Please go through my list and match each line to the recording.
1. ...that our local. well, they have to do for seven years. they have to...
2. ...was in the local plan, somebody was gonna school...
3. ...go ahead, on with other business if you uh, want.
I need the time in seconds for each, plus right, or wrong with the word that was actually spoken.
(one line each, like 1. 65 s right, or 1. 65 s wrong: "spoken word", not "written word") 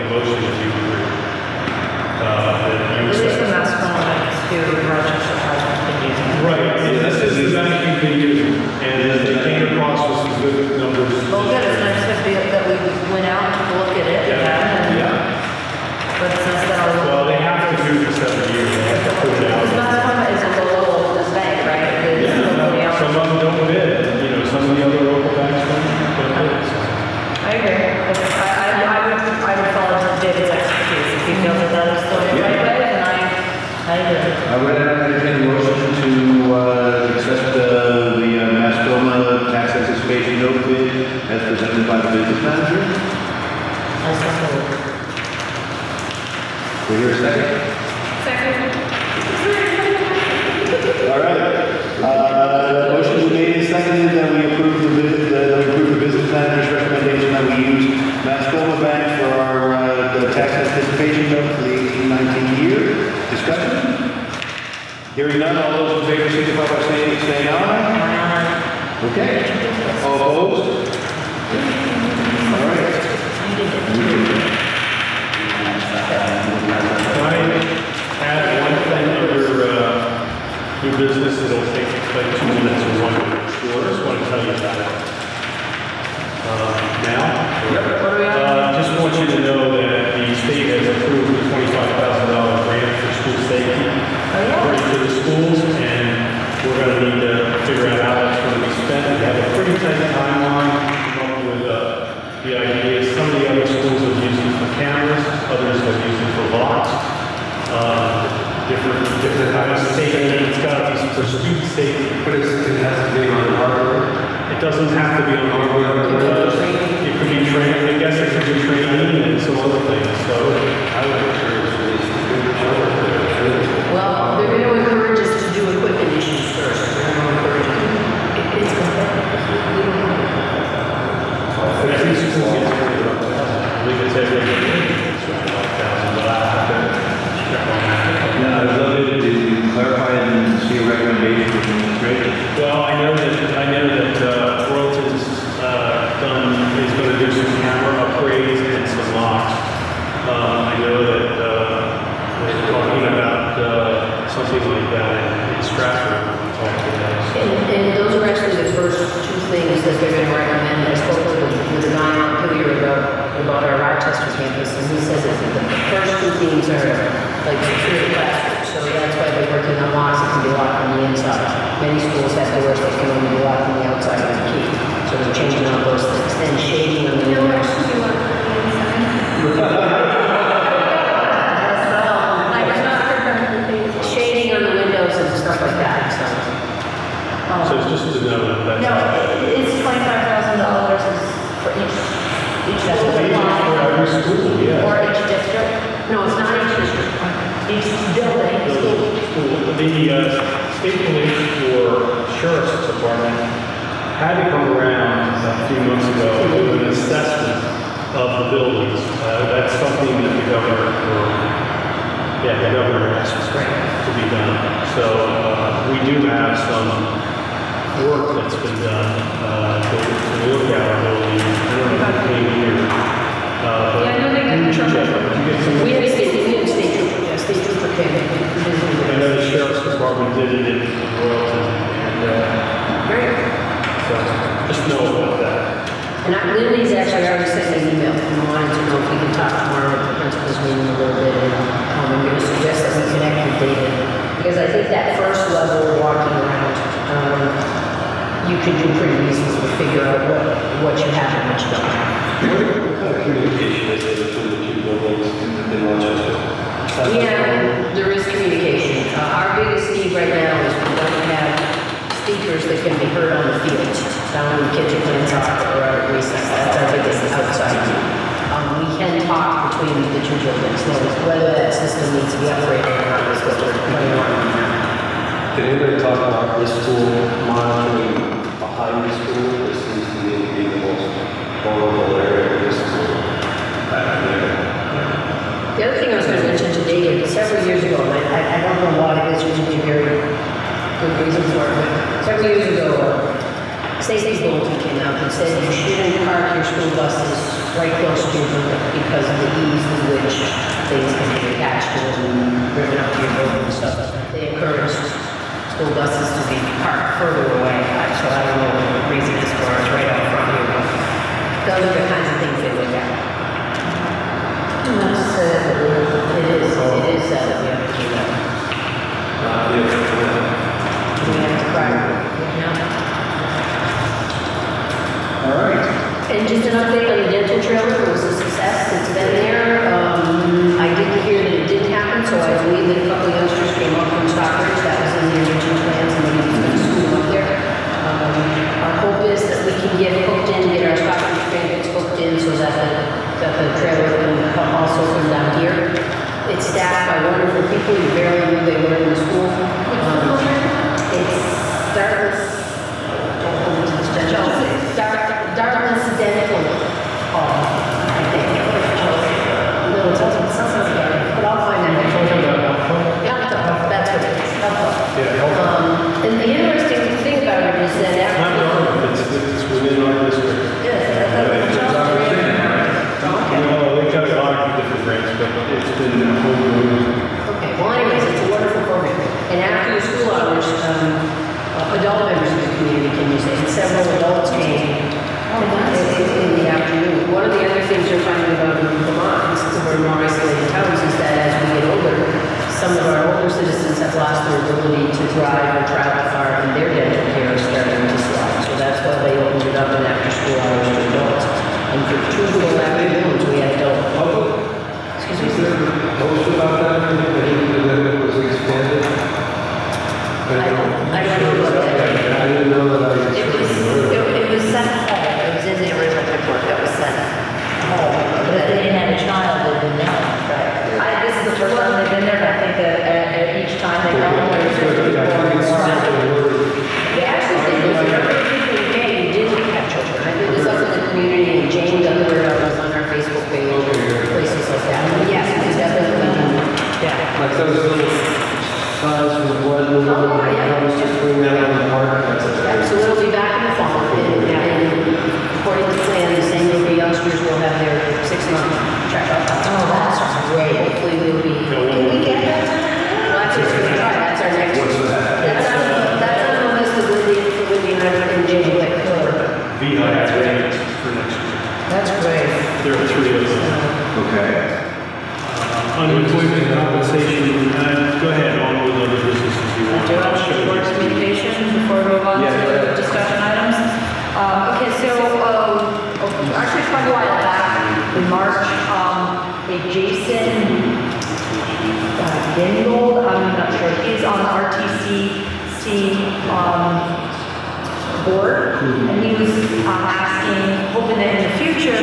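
1. 16 s right
2. 335 s wrong: "original", not "local"
3. 468 s right.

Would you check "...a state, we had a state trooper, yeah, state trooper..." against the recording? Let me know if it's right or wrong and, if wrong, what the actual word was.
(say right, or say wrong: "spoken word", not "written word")
right.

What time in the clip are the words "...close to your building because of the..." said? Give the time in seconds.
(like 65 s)
298 s.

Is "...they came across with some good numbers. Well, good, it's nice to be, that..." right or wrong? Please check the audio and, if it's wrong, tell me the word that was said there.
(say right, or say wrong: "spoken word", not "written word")
right.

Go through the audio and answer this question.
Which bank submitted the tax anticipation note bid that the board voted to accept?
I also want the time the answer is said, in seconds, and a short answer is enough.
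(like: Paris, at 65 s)
Mascoma Bank, at 3 s.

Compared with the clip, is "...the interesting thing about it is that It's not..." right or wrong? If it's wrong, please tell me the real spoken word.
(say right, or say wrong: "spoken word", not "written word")
right.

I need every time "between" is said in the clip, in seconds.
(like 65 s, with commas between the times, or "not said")
254 s, 269 s.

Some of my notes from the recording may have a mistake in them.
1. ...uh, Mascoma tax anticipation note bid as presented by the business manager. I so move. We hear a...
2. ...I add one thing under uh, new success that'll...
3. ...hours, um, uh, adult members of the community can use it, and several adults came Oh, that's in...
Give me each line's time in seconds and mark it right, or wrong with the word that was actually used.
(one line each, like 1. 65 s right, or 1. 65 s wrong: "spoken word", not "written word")
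1. 38 s right
2. 77 s wrong: "business", not "success"
3. 380 s right.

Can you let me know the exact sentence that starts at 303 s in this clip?
So they encourage school buses to be parked further away.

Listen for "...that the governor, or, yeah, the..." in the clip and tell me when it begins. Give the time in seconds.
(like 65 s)
210 s.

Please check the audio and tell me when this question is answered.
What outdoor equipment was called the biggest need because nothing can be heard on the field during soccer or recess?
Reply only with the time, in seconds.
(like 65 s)
262 s.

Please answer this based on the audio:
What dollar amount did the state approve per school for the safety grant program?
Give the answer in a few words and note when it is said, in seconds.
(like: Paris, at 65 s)
$25,000, at 91 s.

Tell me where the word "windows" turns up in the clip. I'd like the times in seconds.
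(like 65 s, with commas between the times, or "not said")
177 s, 184 s.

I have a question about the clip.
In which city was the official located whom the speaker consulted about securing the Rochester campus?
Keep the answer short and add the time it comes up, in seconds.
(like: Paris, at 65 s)
Montpelier, at 162 s.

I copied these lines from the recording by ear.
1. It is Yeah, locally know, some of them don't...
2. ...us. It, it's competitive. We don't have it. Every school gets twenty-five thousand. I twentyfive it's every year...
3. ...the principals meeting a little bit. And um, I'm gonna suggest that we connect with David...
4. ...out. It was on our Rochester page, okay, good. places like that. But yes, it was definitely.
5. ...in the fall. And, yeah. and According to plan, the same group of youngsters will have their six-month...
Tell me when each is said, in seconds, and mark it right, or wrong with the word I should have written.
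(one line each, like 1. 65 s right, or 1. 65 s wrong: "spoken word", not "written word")
1. 22 s right
2. 127 s wrong: "believe", not "twentyfive"
3. 240 s right
4. 432 s wrong: "Facebook", not "Rochester"
5. 443 s right.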